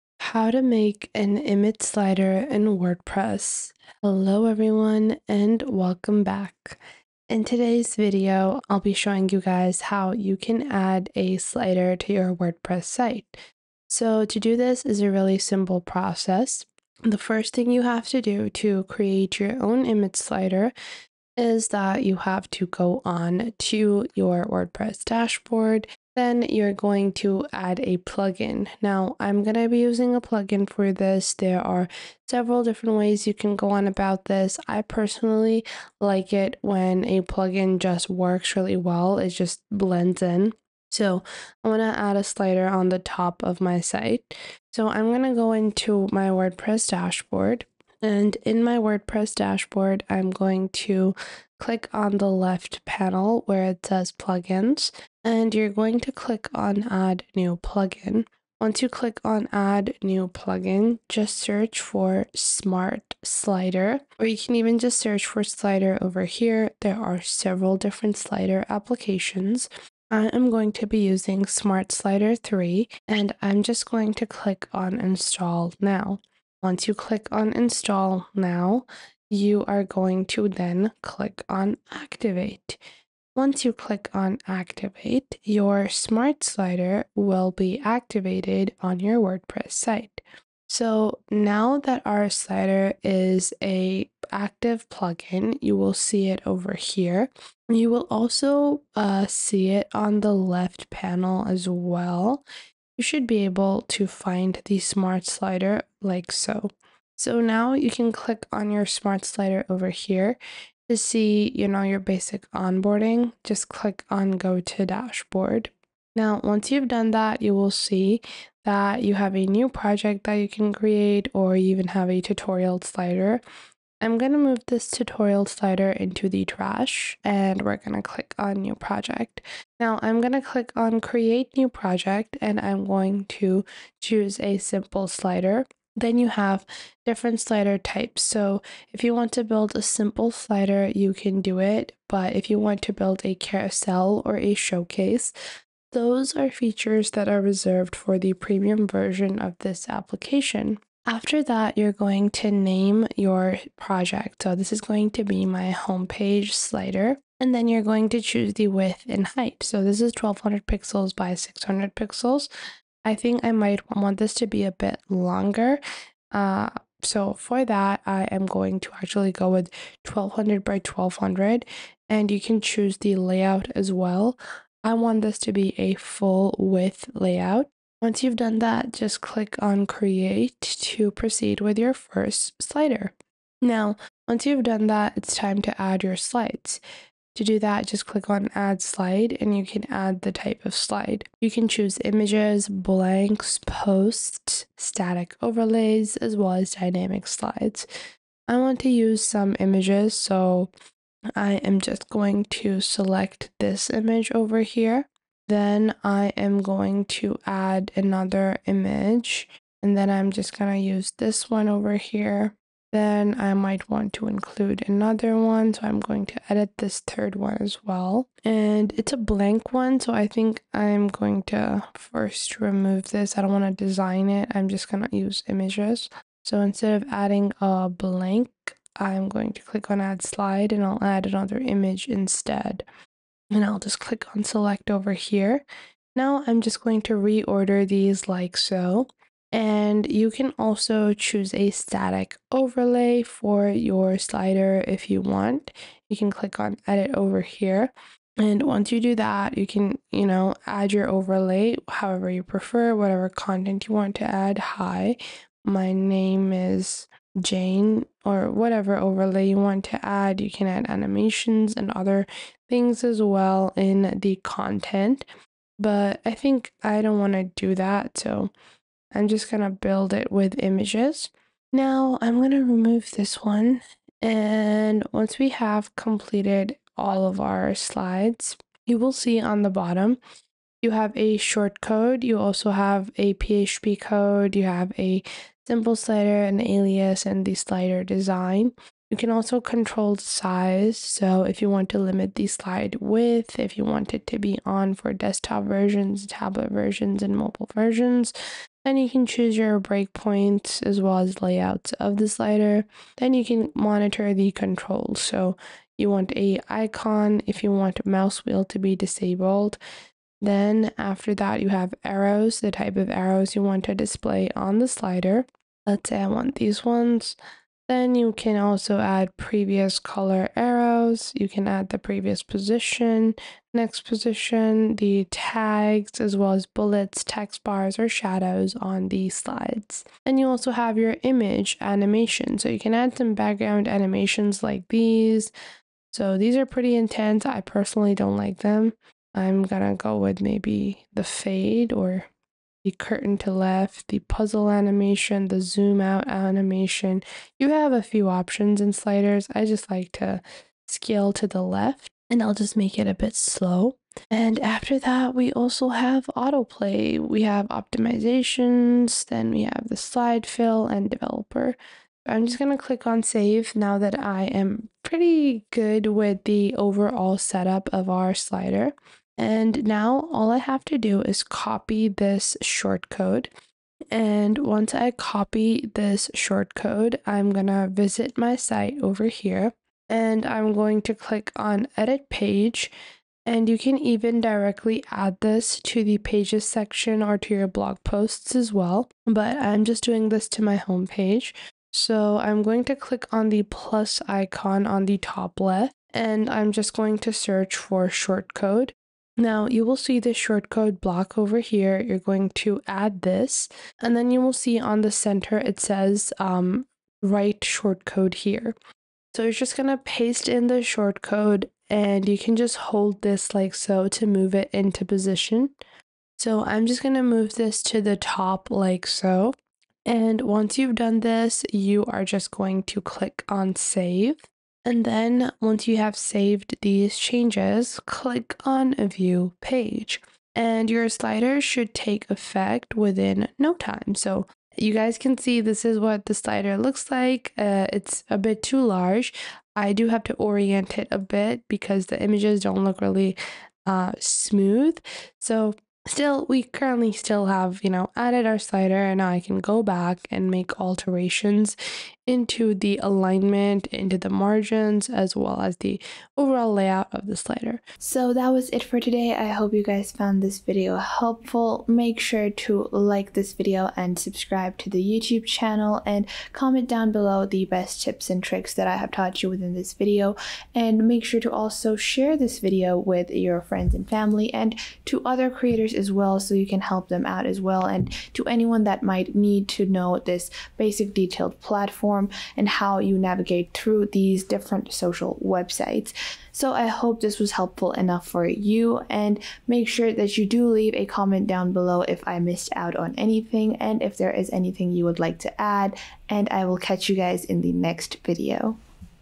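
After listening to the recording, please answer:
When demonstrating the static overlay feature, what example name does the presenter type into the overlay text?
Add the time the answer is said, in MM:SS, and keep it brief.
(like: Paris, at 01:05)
Jane, at 04:17.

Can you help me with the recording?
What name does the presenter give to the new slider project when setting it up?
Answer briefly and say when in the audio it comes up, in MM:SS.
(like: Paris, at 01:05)
homepage slider, at 02:35.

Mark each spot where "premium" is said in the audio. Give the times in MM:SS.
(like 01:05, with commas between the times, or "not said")
02:28.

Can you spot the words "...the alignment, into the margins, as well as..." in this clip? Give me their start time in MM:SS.
07:32.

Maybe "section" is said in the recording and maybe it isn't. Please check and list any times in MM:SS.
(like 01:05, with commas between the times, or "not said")
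06:26.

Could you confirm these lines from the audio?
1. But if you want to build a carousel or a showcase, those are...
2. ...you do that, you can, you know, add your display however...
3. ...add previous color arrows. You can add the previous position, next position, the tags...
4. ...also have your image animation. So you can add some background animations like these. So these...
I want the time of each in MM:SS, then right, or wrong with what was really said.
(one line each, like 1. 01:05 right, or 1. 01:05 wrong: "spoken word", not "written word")
1. 02:22 right
2. 04:08 wrong: "overlay", not "display"
3. 05:19 right
4. 05:30 right.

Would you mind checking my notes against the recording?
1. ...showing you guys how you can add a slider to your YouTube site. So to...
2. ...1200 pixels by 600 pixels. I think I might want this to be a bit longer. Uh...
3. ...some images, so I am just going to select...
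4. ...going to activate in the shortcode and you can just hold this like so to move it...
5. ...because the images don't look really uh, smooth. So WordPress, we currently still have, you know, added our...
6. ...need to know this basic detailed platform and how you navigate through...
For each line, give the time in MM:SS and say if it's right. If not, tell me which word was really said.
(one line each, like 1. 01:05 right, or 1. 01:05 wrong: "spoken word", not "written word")
1. 00:08 wrong: "WordPress", not "YouTube"
2. 02:40 right
3. 03:19 right
4. 06:49 wrong: "paste", not "activate"
5. 07:21 wrong: "Still", not "WordPress"
6. 07:59 right.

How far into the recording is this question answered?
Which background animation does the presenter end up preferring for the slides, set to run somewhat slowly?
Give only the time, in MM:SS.
05:50.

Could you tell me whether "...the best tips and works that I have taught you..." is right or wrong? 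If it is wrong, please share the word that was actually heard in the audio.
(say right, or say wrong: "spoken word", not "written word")
wrong: "tricks", not "works".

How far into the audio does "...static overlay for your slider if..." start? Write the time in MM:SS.
04:01.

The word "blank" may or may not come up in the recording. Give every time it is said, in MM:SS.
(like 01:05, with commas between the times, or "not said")
03:12, 03:39, 03:47.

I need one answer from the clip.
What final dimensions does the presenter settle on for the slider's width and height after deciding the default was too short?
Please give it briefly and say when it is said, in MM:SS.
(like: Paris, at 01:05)
1200 by 1200, at 02:50.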